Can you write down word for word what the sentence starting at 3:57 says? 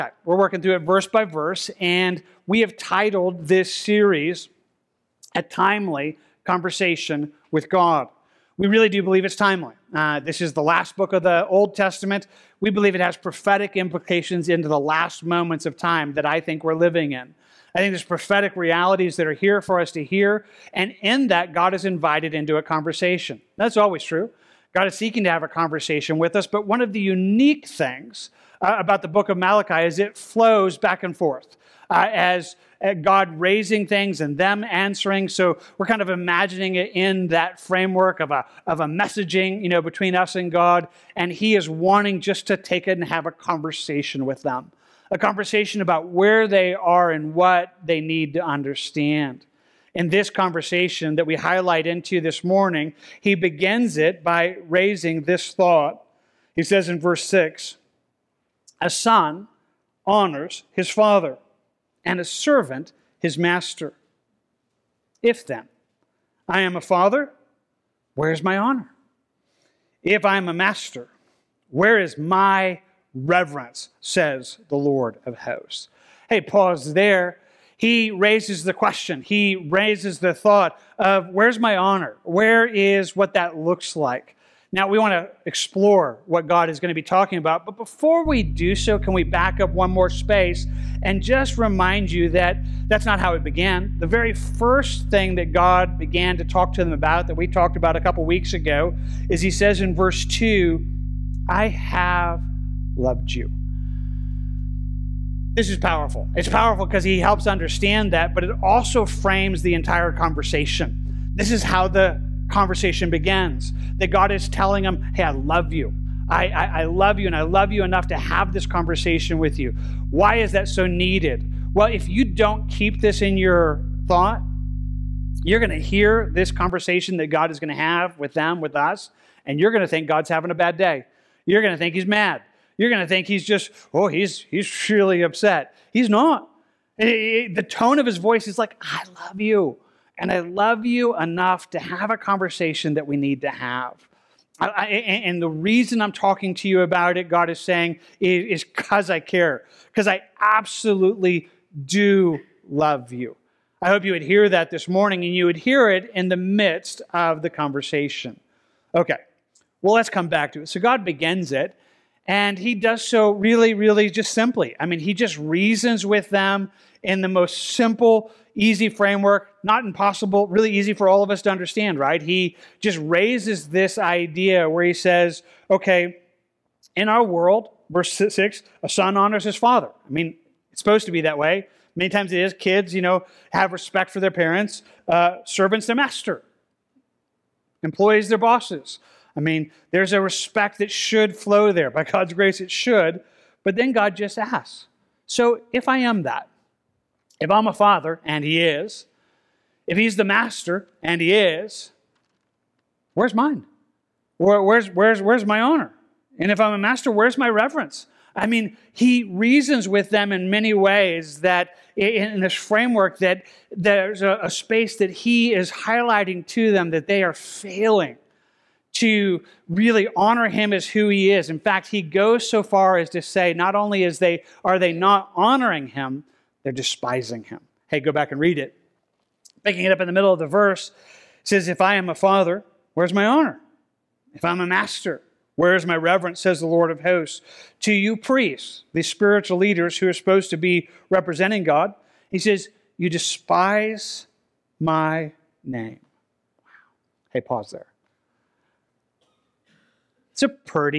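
To you priests, the spiritual leaders who are supposed to be representing God, he says, You despise my name.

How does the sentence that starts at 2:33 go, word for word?
I hope you would hear that this morning and you would hear it in the midst of the conversation.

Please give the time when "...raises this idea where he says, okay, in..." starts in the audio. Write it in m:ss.
2:53.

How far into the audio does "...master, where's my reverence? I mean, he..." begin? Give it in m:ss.
3:26.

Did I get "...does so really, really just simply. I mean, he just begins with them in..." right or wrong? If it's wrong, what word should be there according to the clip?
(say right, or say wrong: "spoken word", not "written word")
wrong: "reasons", not "begins".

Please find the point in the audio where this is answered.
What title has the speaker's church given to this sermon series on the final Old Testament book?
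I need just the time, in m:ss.
0:05.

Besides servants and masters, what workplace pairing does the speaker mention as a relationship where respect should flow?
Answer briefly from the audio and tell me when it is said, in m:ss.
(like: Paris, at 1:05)
employees, their bosses, at 3:07.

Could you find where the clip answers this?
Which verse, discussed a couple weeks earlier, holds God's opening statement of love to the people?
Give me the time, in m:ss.
1:39.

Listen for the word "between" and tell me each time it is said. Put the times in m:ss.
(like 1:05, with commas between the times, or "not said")
0:39.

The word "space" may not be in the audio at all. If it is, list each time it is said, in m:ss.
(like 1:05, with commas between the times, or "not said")
1:30, 3:34.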